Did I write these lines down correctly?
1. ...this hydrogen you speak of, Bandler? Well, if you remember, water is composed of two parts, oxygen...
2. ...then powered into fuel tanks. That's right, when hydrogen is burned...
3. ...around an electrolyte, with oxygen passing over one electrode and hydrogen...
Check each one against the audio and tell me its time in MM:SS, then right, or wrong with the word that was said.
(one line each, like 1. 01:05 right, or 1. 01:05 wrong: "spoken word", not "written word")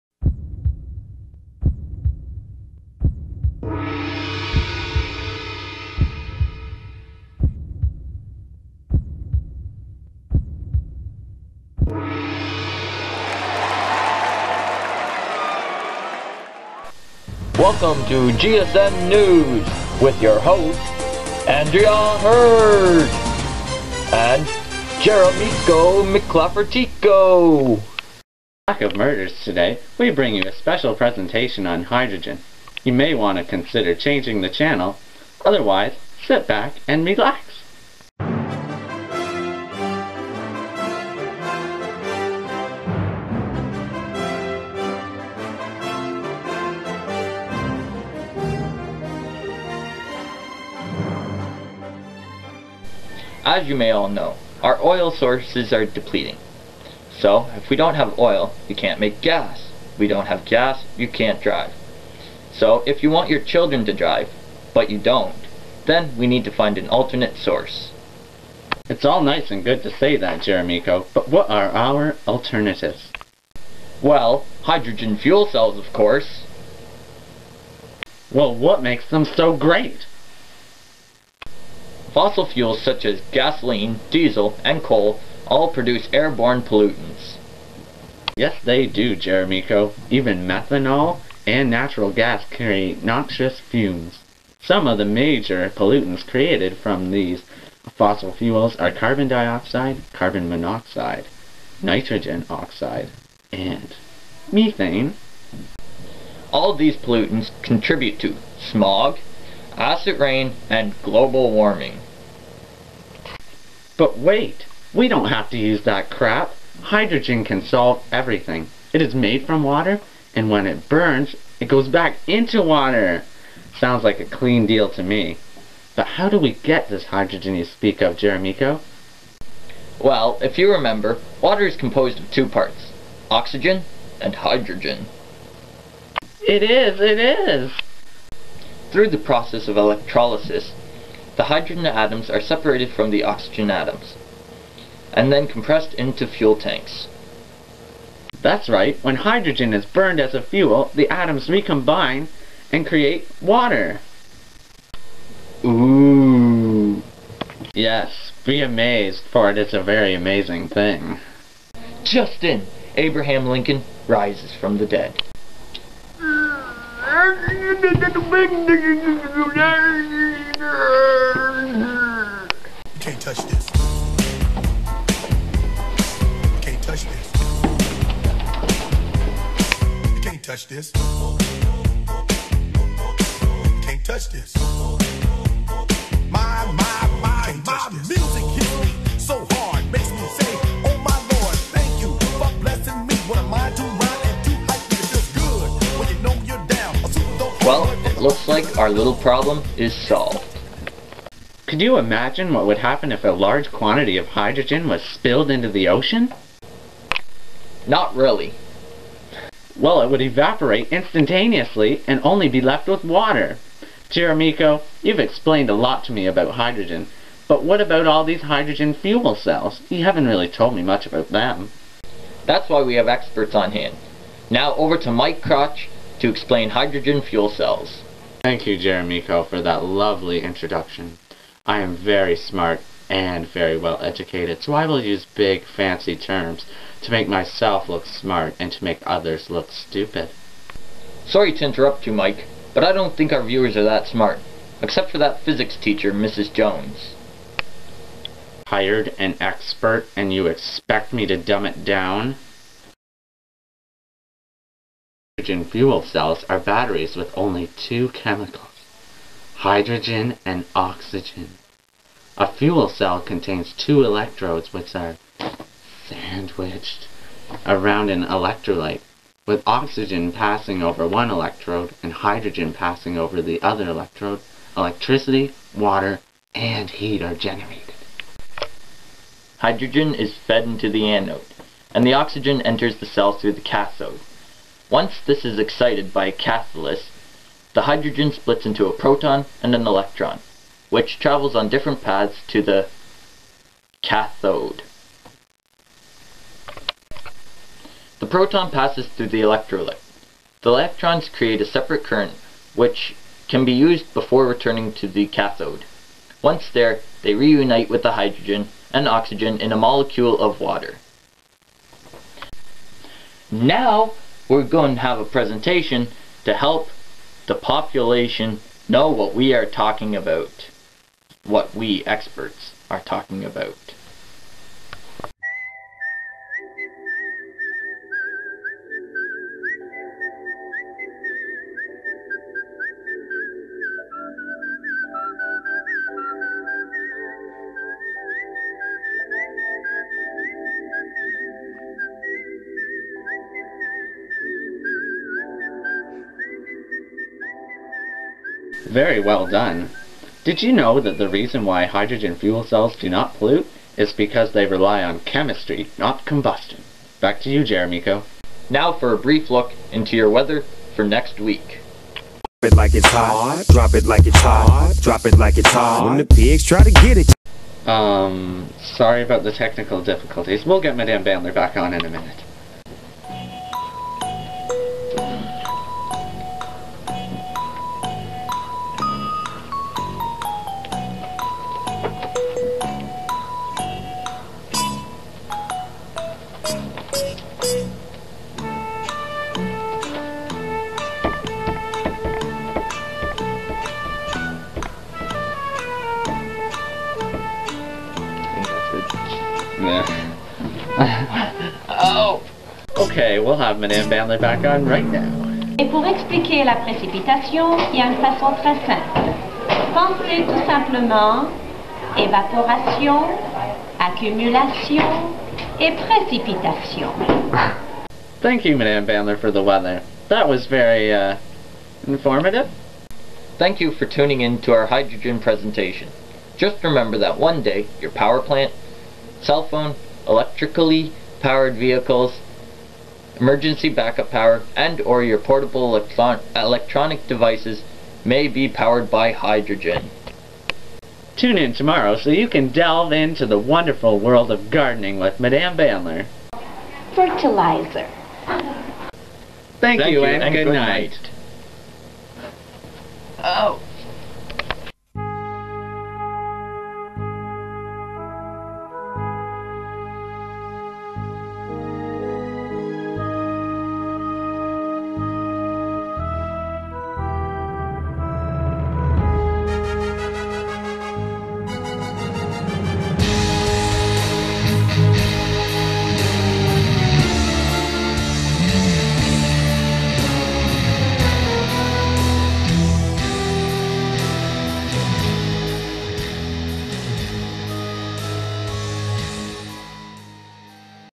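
1. 02:06 wrong: "Jeremico", not "Bandler"
2. 02:25 wrong: "compressed", not "powered"
3. 04:27 right.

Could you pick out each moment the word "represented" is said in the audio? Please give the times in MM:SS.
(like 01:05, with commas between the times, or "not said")
not said.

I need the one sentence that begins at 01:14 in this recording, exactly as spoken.
Well, hydrogen fuel cells, of course.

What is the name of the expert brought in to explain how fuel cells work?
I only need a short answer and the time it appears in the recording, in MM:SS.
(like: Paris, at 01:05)
Mike Crotch, at 03:45.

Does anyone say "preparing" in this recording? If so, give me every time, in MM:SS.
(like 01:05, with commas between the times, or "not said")
not said.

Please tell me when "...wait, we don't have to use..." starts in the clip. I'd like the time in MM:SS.
01:54.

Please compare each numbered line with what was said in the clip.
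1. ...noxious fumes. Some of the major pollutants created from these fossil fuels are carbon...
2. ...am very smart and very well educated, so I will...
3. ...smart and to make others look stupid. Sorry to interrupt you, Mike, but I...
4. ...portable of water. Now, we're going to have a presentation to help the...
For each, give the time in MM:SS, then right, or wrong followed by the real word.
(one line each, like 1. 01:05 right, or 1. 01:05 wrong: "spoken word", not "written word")
1. 01:33 right
2. 03:51 right
3. 03:58 right
4. 05:09 wrong: "molecule", not "portable".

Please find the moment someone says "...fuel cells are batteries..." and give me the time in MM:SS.
04:15.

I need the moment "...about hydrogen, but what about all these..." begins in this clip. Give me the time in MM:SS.
03:36.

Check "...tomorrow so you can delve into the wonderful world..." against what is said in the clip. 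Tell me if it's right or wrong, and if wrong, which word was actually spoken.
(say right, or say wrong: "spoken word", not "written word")
right.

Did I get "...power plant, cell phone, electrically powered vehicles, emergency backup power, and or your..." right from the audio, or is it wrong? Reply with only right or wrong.
right.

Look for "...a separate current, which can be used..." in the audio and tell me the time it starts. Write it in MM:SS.
05:01.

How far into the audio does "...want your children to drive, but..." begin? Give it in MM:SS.
01:03.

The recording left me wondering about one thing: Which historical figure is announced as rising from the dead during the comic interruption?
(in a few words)
Abraham Lincoln.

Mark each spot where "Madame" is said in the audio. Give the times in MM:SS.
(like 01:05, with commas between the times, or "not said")
06:10, 06:43, 06:58, 07:25.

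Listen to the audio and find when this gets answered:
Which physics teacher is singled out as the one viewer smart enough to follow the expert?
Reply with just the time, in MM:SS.
04:06.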